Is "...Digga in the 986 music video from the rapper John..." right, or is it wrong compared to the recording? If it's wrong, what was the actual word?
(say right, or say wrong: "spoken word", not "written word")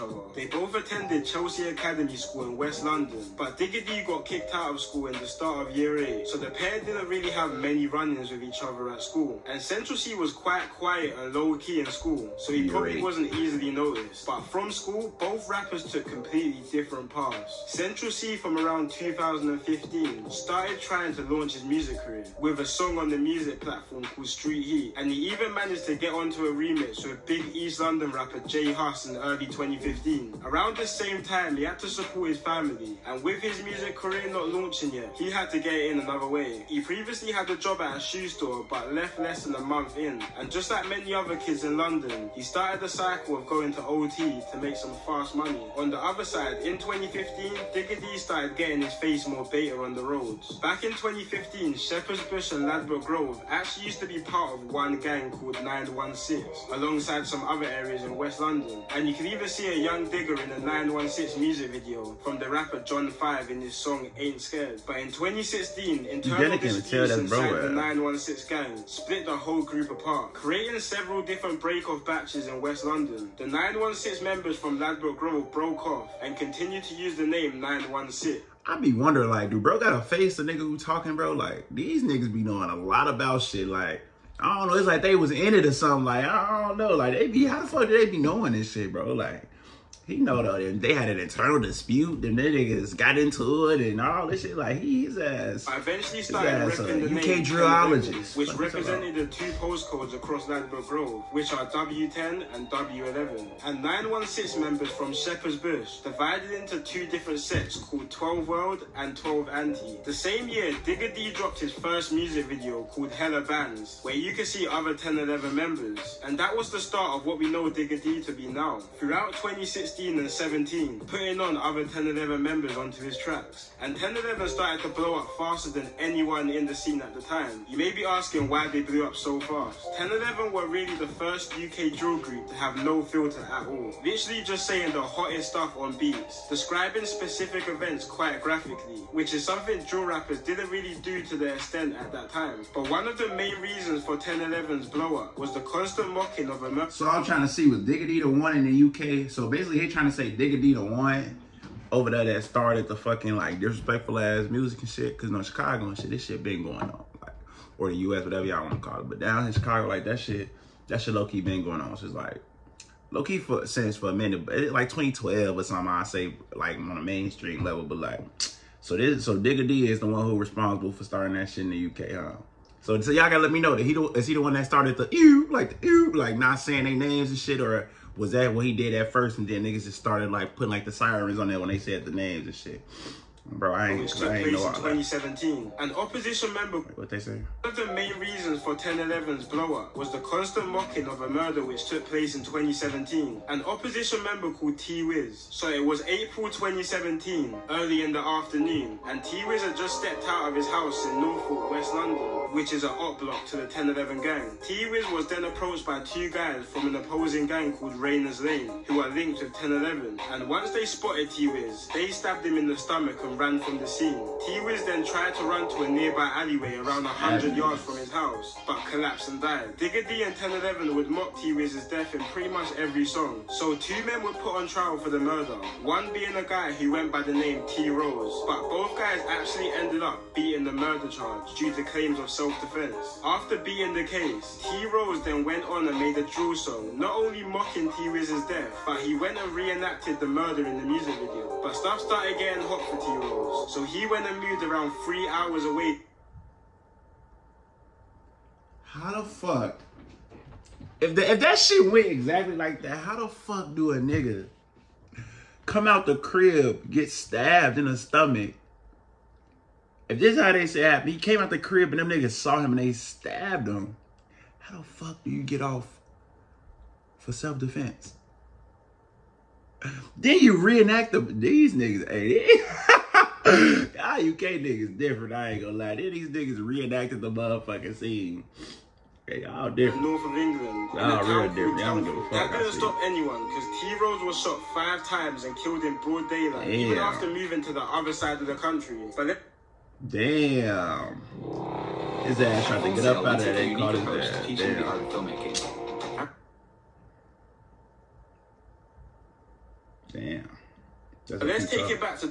wrong: "916", not "986".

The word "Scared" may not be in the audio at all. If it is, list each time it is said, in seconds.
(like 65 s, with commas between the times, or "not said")
64 s.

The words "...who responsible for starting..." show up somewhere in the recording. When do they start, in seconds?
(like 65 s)
170 s.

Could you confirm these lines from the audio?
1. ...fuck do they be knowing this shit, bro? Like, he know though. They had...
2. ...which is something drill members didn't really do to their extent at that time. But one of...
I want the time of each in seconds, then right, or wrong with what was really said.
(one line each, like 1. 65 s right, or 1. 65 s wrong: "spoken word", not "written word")
1. 87 s right
2. 139 s wrong: "rappers", not "members".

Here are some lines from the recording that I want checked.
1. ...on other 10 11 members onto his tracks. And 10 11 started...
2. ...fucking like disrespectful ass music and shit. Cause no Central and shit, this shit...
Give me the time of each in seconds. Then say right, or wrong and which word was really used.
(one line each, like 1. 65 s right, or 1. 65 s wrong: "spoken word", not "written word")
1. 121 s right
2. 152 s wrong: "Chicago", not "Central".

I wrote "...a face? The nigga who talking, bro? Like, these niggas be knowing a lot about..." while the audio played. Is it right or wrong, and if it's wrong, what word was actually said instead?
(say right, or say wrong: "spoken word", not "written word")
right.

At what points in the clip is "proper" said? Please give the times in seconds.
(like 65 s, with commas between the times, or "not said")
not said.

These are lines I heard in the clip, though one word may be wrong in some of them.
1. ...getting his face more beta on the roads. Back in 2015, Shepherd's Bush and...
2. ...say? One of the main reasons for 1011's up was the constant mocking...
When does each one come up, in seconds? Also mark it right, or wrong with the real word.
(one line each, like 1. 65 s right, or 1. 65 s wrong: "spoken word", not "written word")
1. 48 s right
2. 187 s right.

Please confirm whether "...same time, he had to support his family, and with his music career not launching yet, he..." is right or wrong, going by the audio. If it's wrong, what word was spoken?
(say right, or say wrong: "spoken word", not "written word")
right.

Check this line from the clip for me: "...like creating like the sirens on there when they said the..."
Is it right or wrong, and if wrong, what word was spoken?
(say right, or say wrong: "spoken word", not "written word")
wrong: "putting", not "creating".